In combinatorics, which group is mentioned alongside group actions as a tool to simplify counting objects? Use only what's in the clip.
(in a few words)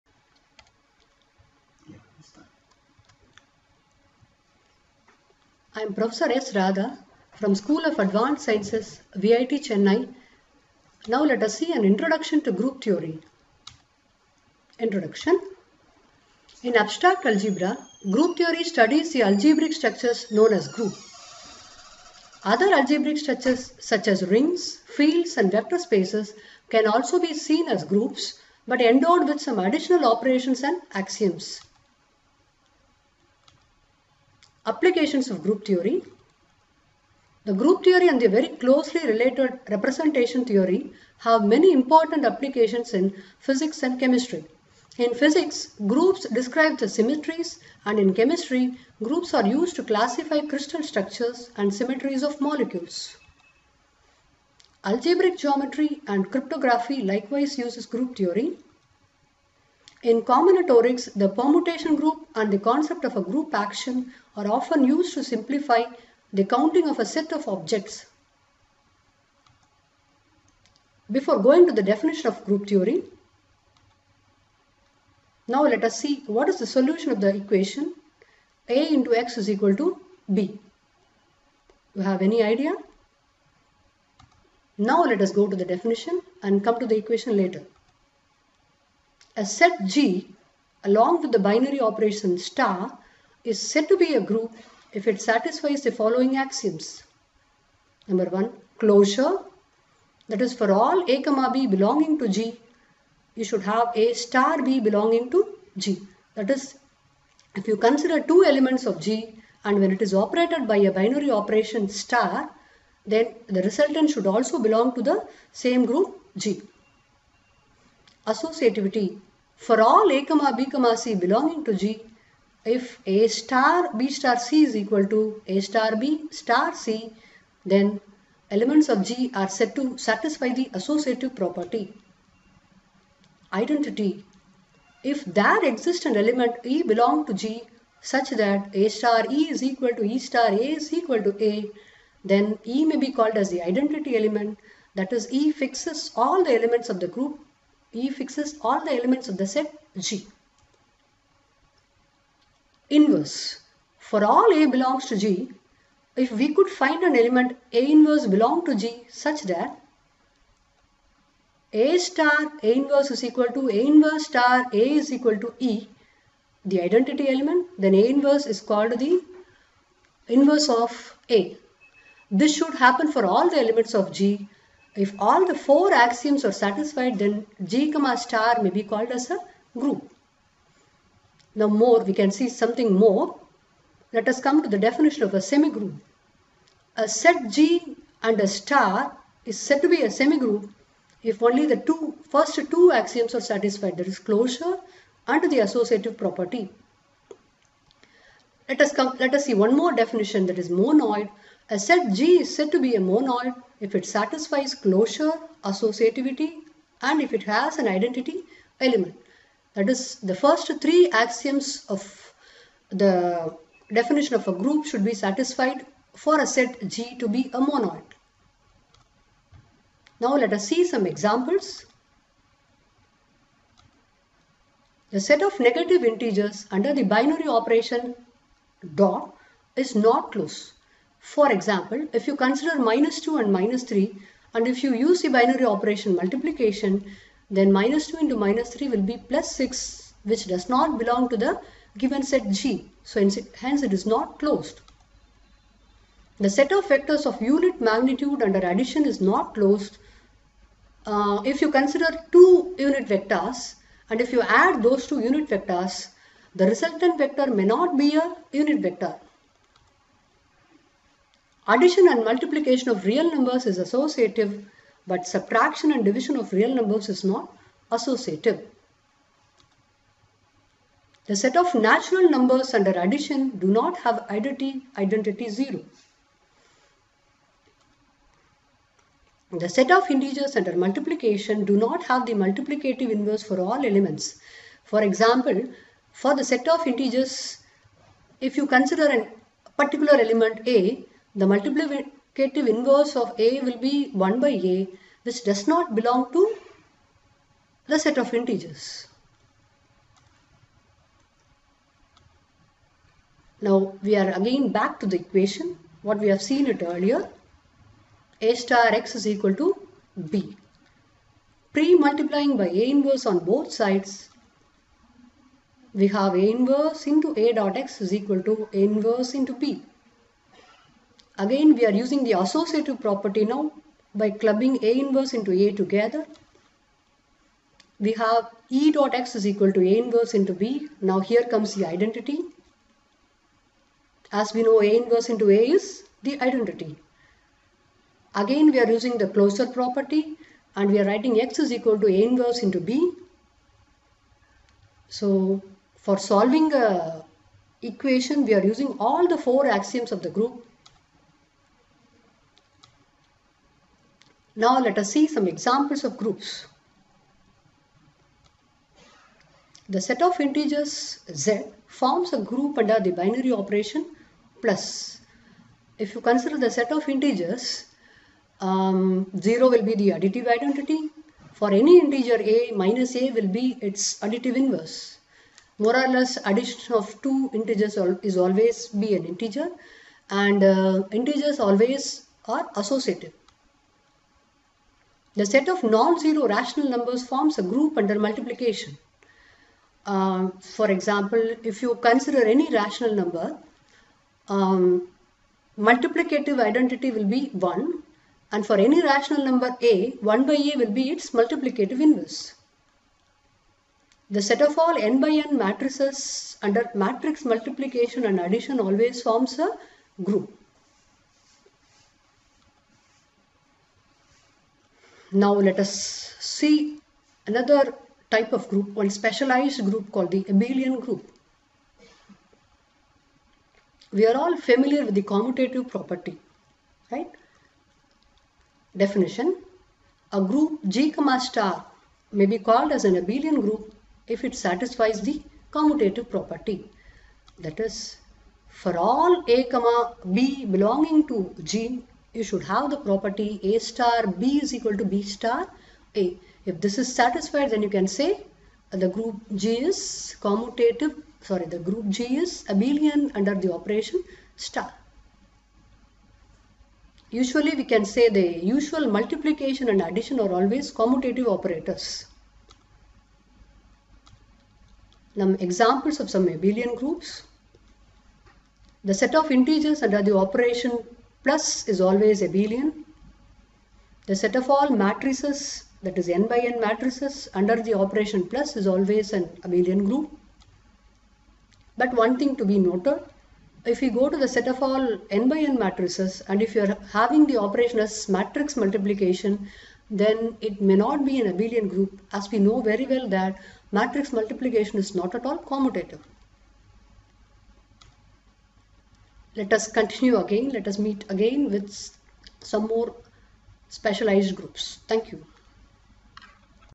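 Permutation group.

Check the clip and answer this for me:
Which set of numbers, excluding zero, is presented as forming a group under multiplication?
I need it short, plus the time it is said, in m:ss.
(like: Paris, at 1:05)
Rational numbers, at 6:25.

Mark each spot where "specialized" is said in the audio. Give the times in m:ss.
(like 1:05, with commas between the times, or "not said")
6:59, 8:23.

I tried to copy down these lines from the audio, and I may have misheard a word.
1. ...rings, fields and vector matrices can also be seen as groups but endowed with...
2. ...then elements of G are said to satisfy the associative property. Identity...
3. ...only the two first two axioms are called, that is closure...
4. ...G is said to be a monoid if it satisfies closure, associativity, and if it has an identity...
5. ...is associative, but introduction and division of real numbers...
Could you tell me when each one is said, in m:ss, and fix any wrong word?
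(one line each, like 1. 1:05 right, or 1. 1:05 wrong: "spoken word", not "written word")
1. 0:24 wrong: "spaces", not "matrices"
2. 2:07 right
3. 3:11 wrong: "satisfied", not "called"
4. 3:22 right
5. 4:23 wrong: "subtraction", not "introduction".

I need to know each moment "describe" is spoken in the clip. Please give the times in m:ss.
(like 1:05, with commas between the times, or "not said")
0:46.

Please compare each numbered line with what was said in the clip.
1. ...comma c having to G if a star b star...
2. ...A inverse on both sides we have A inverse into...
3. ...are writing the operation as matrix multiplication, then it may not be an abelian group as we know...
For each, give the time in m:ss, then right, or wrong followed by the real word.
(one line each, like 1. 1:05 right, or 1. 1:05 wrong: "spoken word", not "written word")
1. 2:00 wrong: "belonging", not "having"
2. 5:12 right
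3. 8:06 wrong: "having", not "writing".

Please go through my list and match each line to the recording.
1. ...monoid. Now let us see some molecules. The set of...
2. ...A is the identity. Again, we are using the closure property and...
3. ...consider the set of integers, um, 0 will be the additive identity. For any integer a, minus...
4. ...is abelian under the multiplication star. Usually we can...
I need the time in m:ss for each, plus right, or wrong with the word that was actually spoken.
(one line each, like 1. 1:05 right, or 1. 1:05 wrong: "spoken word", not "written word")
1. 3:37 wrong: "examples", not "molecules"
2. 5:35 right
3. 6:06 right
4. 7:32 wrong: "operation", not "multiplication".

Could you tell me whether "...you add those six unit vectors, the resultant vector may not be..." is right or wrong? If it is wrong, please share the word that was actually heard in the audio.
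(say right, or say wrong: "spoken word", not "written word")
wrong: "two", not "six".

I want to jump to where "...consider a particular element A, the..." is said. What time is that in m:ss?
4:48.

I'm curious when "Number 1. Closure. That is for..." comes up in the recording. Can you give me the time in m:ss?
1:38.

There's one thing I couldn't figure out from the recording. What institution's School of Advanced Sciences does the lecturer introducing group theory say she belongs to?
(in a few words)
VIT Chennai.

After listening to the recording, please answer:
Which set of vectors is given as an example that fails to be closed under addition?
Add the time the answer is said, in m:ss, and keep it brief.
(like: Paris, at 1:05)
Vectors of unit magnitude, at 4:06.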